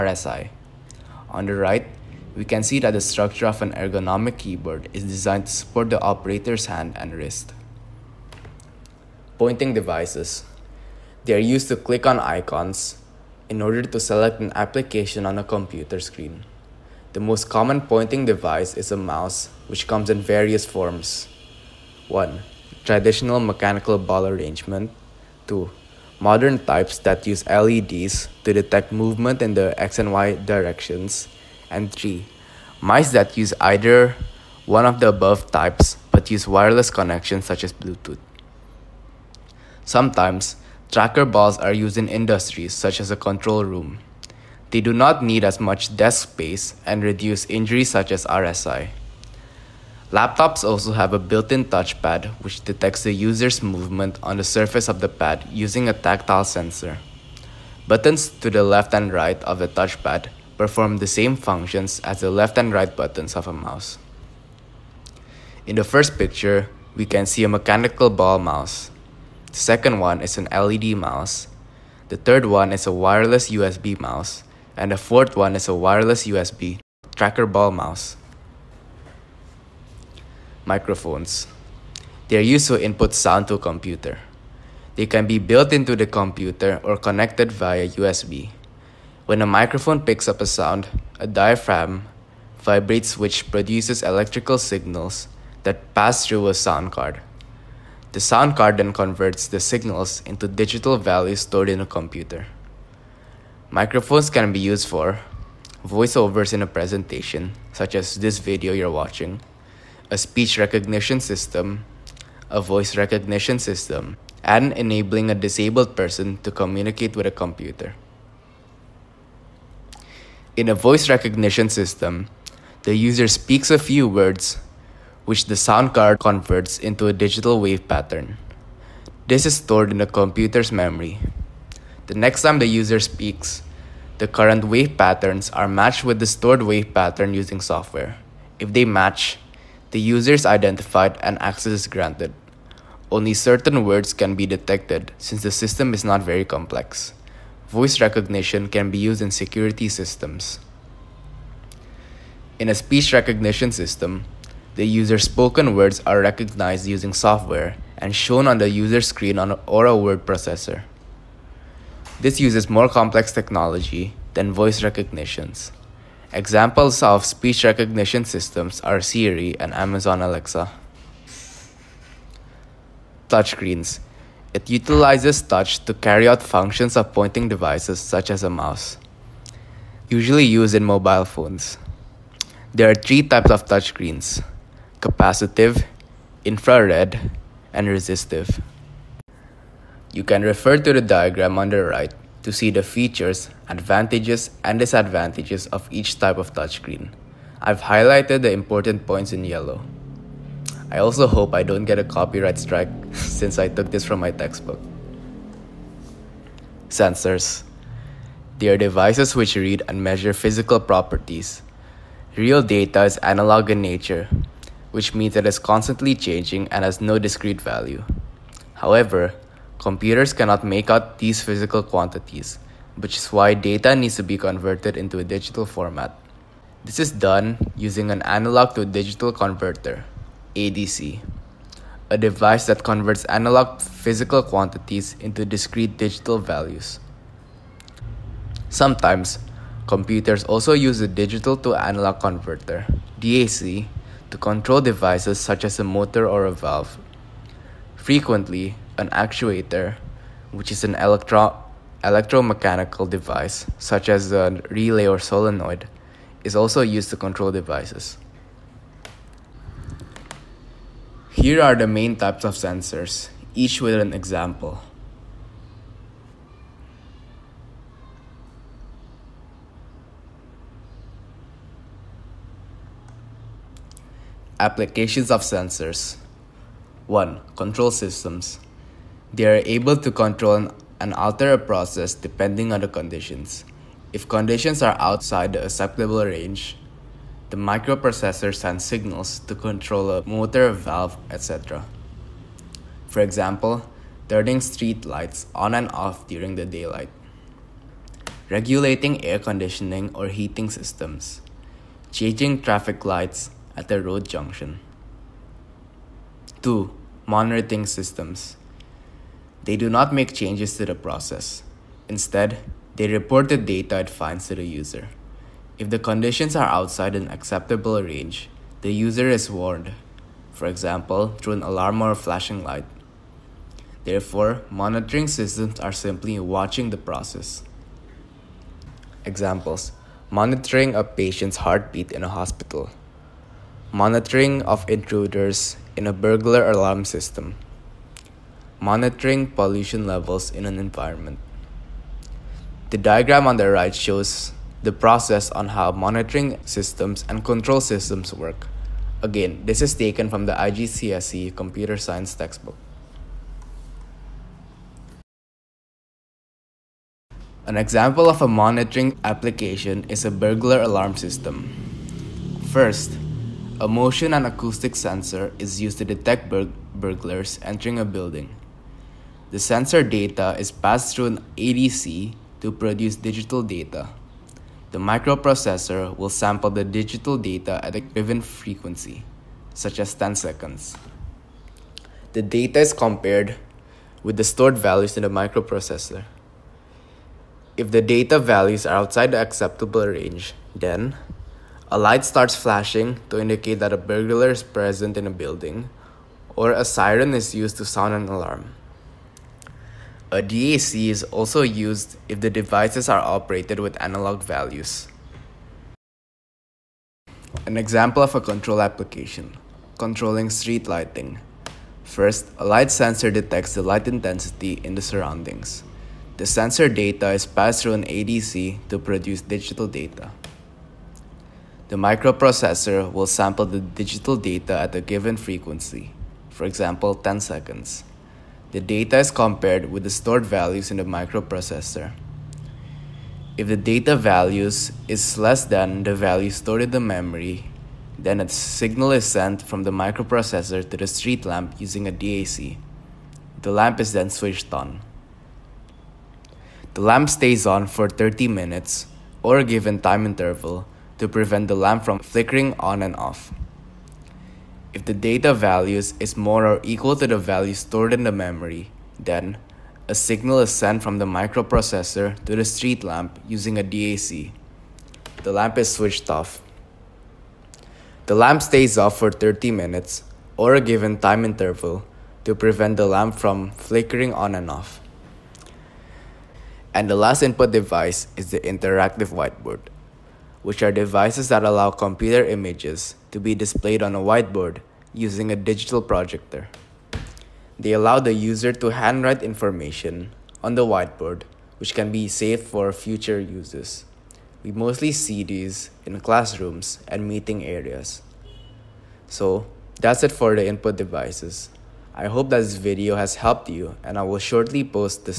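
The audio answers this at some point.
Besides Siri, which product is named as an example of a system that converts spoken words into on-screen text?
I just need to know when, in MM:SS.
02:49.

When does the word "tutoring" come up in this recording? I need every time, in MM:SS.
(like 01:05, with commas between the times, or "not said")
not said.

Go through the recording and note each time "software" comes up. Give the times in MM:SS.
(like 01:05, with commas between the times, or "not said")
02:17, 02:37.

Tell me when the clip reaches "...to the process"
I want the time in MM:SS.
05:10.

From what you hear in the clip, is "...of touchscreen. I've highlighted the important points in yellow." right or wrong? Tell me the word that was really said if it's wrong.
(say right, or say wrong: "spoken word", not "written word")
right.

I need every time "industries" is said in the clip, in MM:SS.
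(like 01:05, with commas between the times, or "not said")
00:42.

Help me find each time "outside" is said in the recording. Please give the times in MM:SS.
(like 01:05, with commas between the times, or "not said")
04:45, 05:16, 06:28.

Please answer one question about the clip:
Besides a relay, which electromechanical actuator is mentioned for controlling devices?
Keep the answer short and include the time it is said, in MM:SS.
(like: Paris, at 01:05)
solenoid, at 04:15.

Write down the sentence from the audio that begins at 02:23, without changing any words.
Only certain words can be detected since the system is not very complex.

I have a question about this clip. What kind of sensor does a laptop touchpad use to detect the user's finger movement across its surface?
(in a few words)
tactile sensor.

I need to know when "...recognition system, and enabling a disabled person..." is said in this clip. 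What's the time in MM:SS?
01:52.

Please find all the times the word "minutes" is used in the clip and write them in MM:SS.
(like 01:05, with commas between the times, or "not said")
07:28, 07:49.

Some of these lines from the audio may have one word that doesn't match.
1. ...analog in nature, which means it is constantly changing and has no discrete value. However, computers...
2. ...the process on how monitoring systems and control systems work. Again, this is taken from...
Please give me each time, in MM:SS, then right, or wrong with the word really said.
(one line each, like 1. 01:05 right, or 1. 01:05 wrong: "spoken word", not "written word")
1. 03:33 right
2. 05:44 right.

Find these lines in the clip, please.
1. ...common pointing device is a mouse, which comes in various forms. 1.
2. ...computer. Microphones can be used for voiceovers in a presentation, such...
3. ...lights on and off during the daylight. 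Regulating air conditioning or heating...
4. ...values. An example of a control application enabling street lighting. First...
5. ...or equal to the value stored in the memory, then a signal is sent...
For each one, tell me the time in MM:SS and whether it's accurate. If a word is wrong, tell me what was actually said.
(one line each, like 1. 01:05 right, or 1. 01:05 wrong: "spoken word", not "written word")
1. 00:17 right
2. 01:41 right
3. 04:55 right
4. 06:44 wrong: "controlling", not "enabling"
5. 07:36 right.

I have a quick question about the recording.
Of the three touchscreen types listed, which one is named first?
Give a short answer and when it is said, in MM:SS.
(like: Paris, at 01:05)
capacitive, at 03:05.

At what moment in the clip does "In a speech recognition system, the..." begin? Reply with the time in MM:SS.
02:32.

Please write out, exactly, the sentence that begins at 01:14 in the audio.
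And the fourth one is a wireless USB tracker ball mouse.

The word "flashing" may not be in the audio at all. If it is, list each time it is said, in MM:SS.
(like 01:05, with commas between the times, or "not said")
05:22, 06:32.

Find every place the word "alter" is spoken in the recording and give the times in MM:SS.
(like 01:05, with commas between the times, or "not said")
04:41.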